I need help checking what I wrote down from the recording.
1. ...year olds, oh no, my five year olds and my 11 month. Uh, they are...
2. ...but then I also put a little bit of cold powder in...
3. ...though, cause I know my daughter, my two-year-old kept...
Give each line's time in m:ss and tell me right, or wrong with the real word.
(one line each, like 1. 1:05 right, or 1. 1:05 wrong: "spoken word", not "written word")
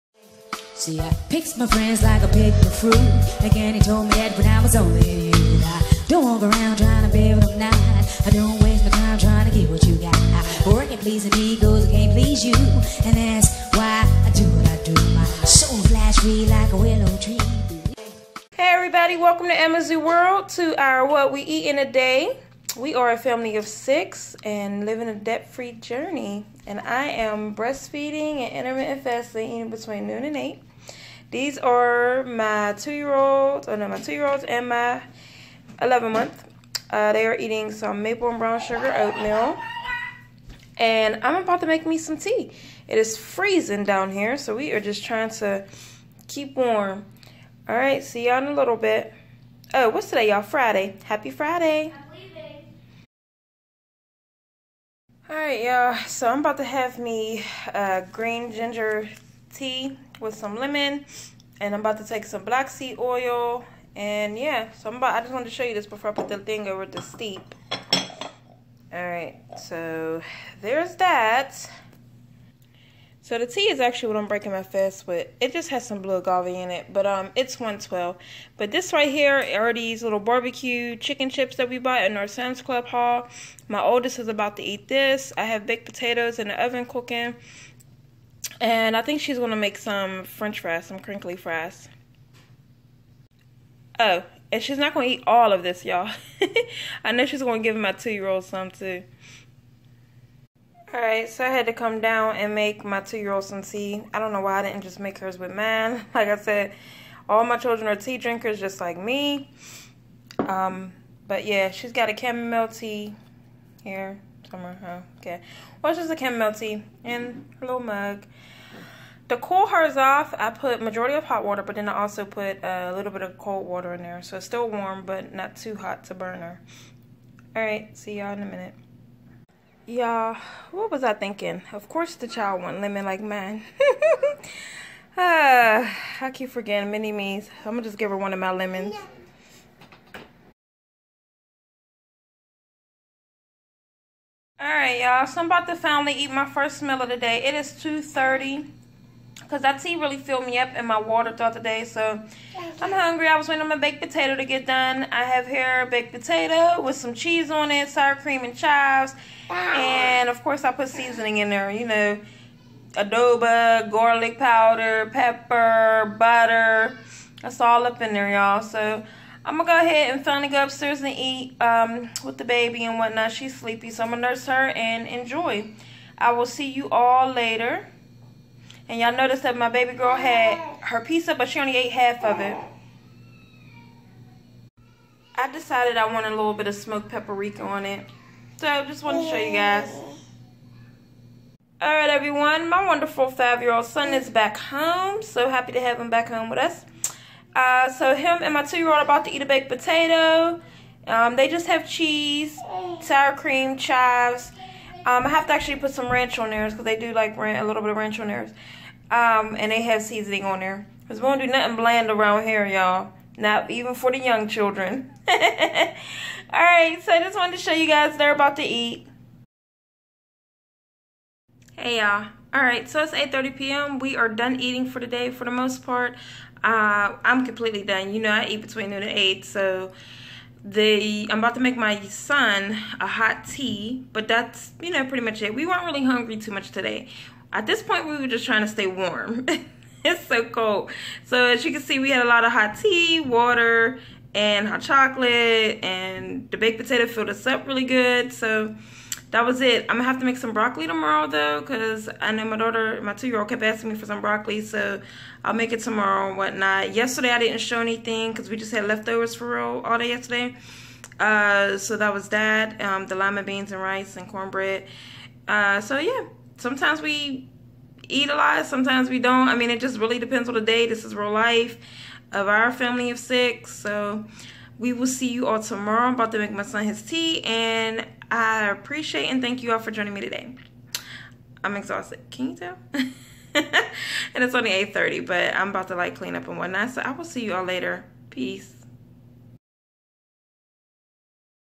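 1. 0:32 wrong: "two", not "five"
2. 2:01 wrong: "water", not "powder"
3. 4:11 right.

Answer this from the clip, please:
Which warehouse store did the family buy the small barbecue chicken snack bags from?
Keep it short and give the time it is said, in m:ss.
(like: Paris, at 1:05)
Sam's Club, at 1:22.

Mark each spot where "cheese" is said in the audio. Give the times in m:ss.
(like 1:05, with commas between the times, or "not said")
2:37, 3:21.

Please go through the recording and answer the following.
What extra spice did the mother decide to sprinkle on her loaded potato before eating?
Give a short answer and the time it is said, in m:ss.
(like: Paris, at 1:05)
smoked paprika, at 3:06.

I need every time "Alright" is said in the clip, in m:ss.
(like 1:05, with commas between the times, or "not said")
1:40, 3:11, 3:35, 3:42.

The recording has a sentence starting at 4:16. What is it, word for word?
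Yesterday I didn't show anything, cause we just had leftovers for real all day yesterday.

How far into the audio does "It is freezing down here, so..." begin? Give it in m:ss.
0:42.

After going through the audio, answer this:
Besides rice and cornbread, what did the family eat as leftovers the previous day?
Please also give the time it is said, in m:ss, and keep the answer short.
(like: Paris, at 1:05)
lima beans, at 4:23.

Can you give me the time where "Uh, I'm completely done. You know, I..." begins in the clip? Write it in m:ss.
3:46.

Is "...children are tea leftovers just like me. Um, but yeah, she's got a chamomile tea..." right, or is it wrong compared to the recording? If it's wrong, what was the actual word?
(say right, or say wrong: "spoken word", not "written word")
wrong: "drinkers", not "leftovers".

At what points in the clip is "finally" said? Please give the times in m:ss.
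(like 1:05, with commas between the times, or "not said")
2:25, 2:50.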